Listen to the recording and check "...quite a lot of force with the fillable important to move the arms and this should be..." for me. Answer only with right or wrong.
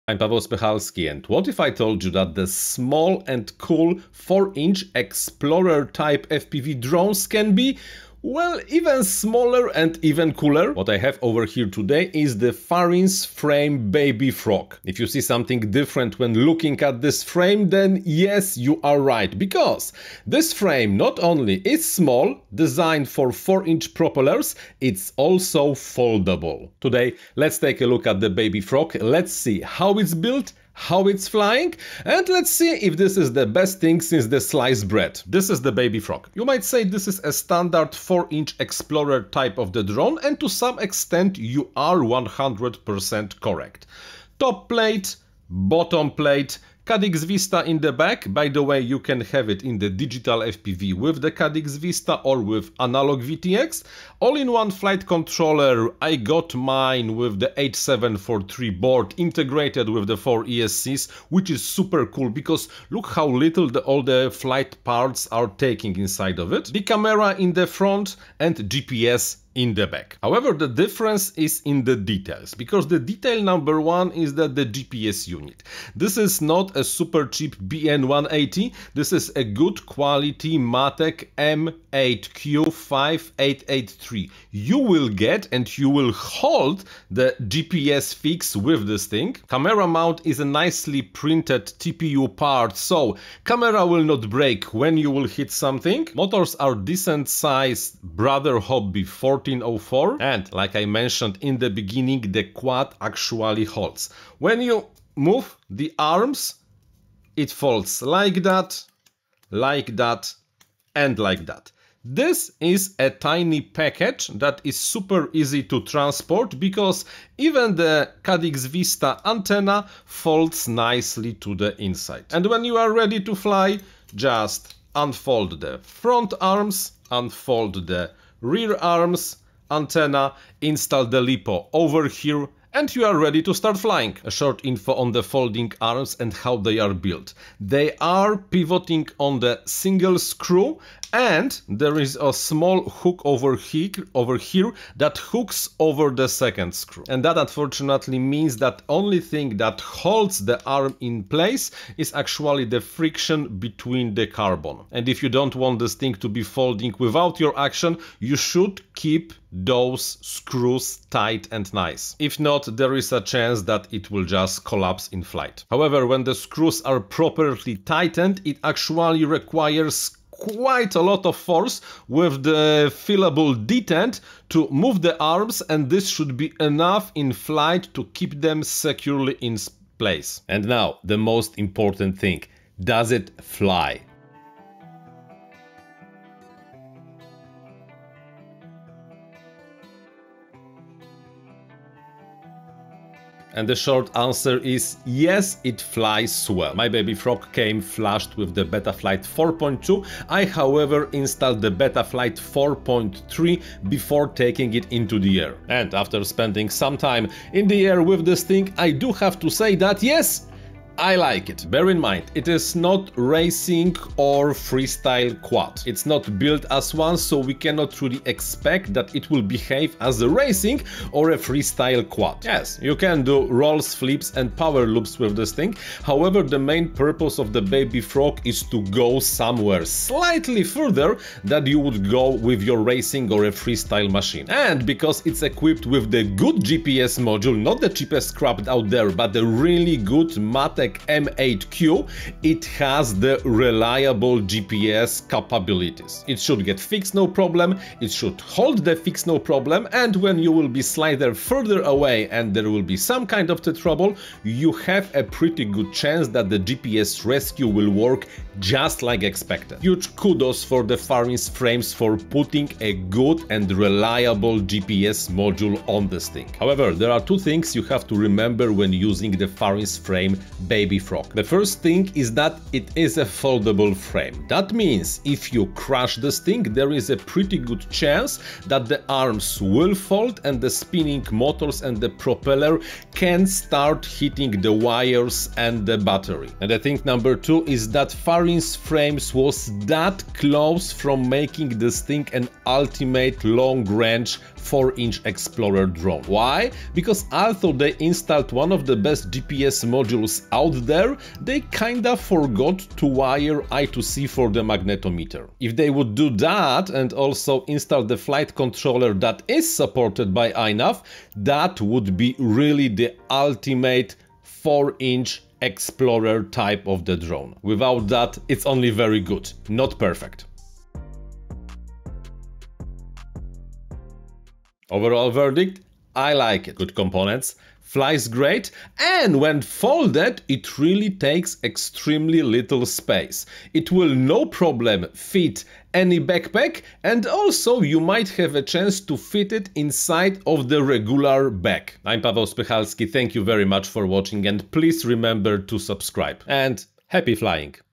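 wrong.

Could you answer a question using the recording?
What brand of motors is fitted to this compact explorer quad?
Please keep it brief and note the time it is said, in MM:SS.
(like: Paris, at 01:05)
BrotherHobby, at 01:38.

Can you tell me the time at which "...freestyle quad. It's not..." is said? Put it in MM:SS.
03:34.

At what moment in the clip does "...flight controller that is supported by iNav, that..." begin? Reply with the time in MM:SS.
05:08.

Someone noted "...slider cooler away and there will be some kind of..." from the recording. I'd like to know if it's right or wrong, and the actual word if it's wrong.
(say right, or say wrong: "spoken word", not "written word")
wrong: "further", not "cooler".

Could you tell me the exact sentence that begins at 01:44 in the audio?
When you move the arms it folds like that, like that and like that.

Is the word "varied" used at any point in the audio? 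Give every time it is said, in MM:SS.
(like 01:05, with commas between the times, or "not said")
not said.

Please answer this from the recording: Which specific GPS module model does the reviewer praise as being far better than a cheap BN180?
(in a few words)
Matek M8Q5883.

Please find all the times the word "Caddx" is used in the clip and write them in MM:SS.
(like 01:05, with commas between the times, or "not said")
00:46, 00:51, 01:58.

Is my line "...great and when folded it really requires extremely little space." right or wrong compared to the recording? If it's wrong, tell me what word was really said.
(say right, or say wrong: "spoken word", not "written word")
wrong: "takes", not "requires".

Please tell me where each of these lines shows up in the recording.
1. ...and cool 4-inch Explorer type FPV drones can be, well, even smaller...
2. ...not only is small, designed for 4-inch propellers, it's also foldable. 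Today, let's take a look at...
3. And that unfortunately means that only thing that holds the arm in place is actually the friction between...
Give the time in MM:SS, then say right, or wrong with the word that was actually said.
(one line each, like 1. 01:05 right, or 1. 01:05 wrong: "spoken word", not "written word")
1. 00:03 right
2. 00:20 right
3. 02:27 right.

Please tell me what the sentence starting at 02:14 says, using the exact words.
A short info on the folding arms and how they are built.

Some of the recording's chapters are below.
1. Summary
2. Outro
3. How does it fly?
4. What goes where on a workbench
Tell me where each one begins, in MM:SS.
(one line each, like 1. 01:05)
1. 05:24
2. 05:42
3. 03:00
4. 00:35.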